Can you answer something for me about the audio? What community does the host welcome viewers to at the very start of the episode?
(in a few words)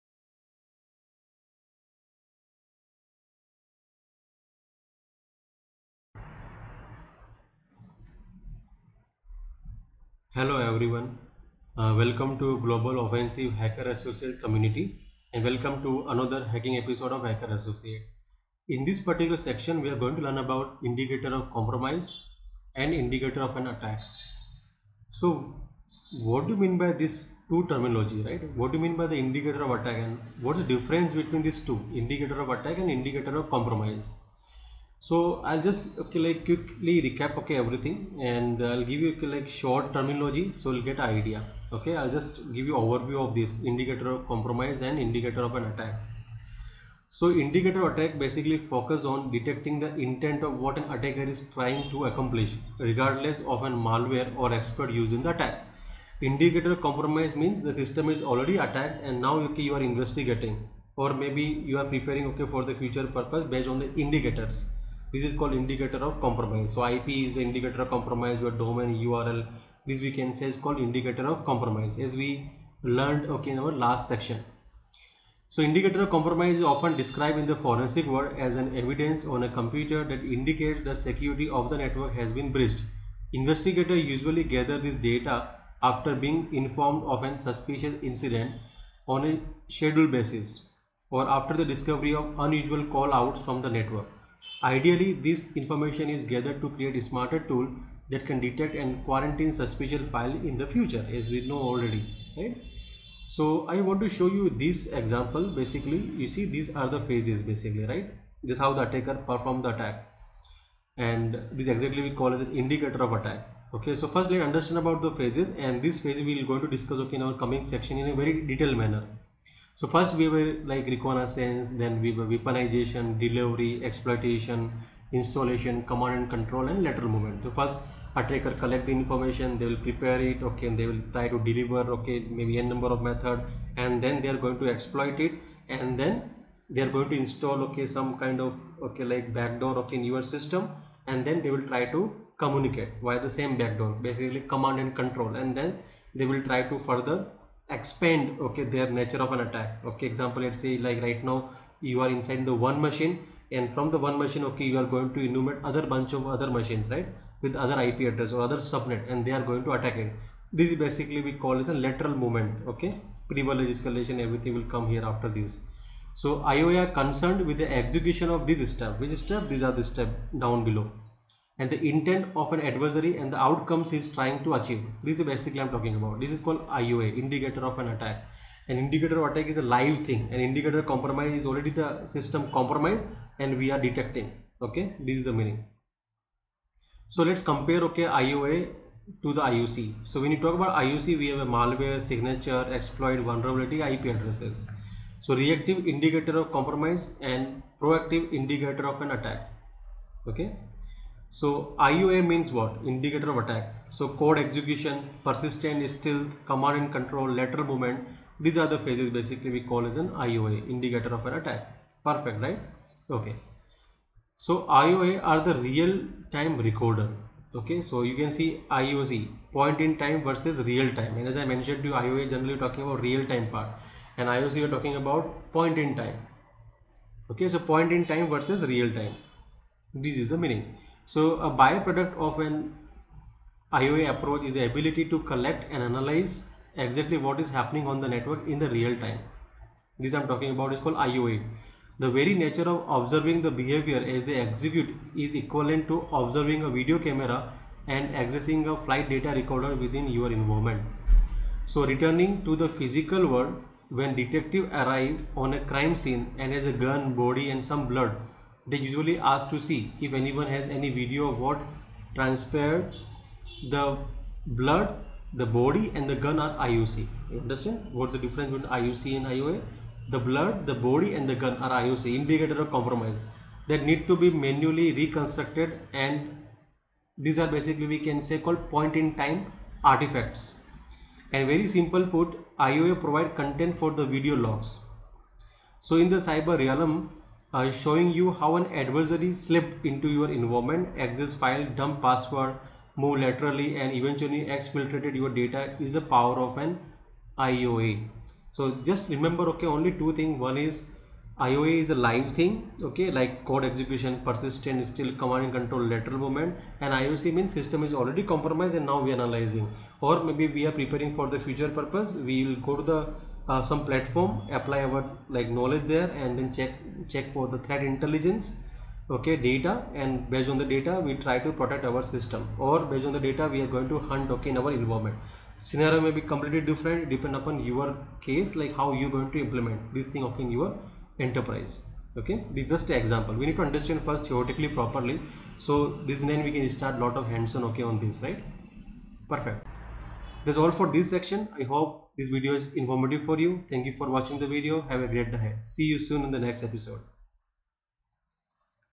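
Global Offensive Hacker Associate.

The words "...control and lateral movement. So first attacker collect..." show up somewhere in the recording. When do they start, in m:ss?
2:06.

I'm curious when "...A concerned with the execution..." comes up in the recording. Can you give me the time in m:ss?
2:46.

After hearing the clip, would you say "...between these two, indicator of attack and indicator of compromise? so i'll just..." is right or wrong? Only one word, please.
right.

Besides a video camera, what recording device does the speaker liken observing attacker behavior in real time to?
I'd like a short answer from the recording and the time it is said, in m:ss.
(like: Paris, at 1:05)
Flight data recorder, at 4:08.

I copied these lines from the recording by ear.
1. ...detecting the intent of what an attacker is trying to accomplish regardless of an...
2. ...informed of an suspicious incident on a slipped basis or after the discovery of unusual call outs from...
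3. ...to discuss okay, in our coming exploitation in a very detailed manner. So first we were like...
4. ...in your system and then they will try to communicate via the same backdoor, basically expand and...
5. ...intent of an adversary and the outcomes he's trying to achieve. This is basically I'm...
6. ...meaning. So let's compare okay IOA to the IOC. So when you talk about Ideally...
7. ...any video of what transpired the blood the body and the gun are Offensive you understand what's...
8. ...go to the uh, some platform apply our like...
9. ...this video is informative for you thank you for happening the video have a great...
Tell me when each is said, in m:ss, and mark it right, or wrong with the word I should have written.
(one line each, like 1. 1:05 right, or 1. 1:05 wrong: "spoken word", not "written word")
1. 0:49 right
2. 1:26 wrong: "scheduled", not "slipped"
3. 1:56 wrong: "section", not "exploitation"
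4. 2:19 wrong: "command", not "expand"
5. 2:51 right
6. 3:05 wrong: "IOC", not "Ideally"
7. 4:20 wrong: "IOC", not "Offensive"
8. 5:12 right
9. 5:42 wrong: "watching", not "happening".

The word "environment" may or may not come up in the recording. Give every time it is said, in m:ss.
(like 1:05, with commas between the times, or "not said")
4:10, 4:50, 5:24.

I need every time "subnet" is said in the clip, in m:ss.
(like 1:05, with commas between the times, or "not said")
2:38.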